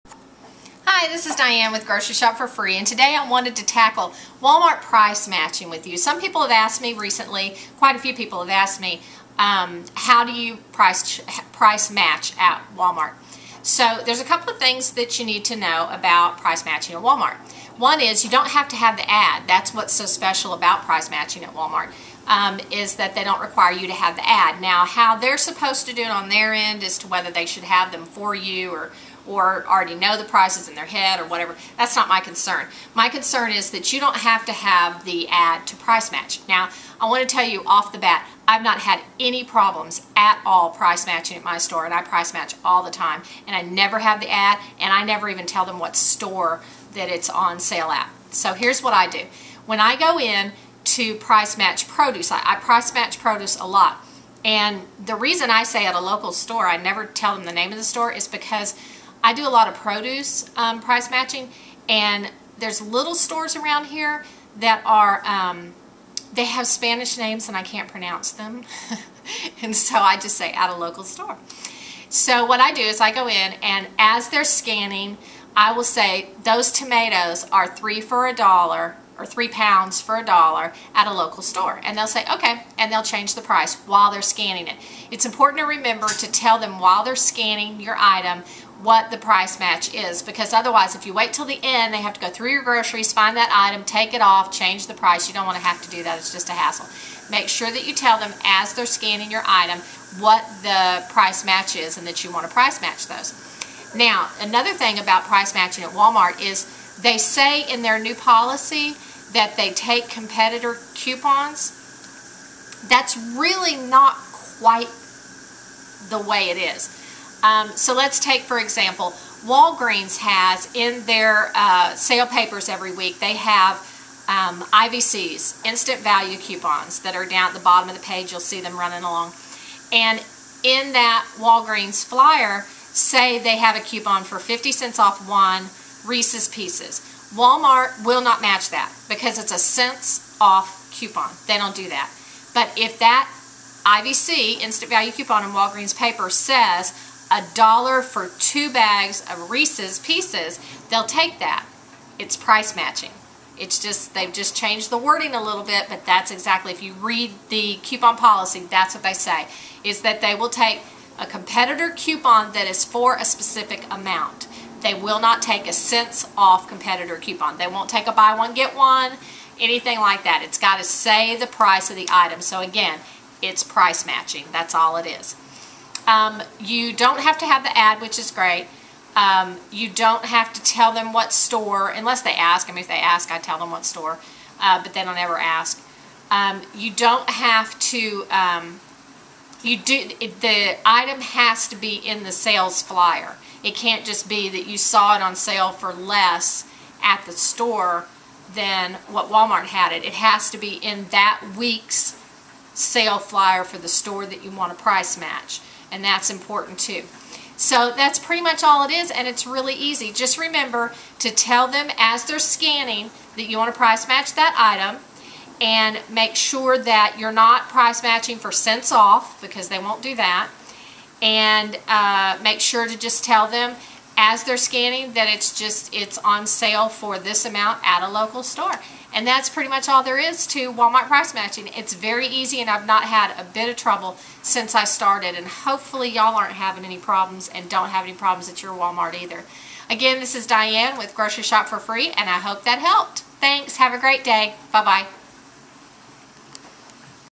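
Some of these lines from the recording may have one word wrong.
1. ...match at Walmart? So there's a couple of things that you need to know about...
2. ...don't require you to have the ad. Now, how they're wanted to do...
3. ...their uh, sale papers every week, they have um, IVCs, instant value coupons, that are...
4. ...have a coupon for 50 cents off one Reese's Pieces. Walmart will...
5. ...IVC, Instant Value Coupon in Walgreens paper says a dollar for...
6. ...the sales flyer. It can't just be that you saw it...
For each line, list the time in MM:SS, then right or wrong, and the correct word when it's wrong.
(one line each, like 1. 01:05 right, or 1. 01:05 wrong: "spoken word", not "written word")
1. 00:11 right
2. 00:23 wrong: "supposed", not "wanted"
3. 02:01 right
4. 02:13 right
5. 02:23 right
6. 03:12 right.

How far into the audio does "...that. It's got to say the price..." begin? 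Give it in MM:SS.
02:50.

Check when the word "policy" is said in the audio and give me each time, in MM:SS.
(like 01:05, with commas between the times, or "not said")
01:48, 02:38.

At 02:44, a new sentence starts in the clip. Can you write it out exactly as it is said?
They will not take a cents off competitor coupon.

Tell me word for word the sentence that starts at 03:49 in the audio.
And that's pretty much all there is to Walmart price matching.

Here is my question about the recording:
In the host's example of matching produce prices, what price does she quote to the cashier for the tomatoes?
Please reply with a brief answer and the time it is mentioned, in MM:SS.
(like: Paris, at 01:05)
3 for a dollar, at 01:17.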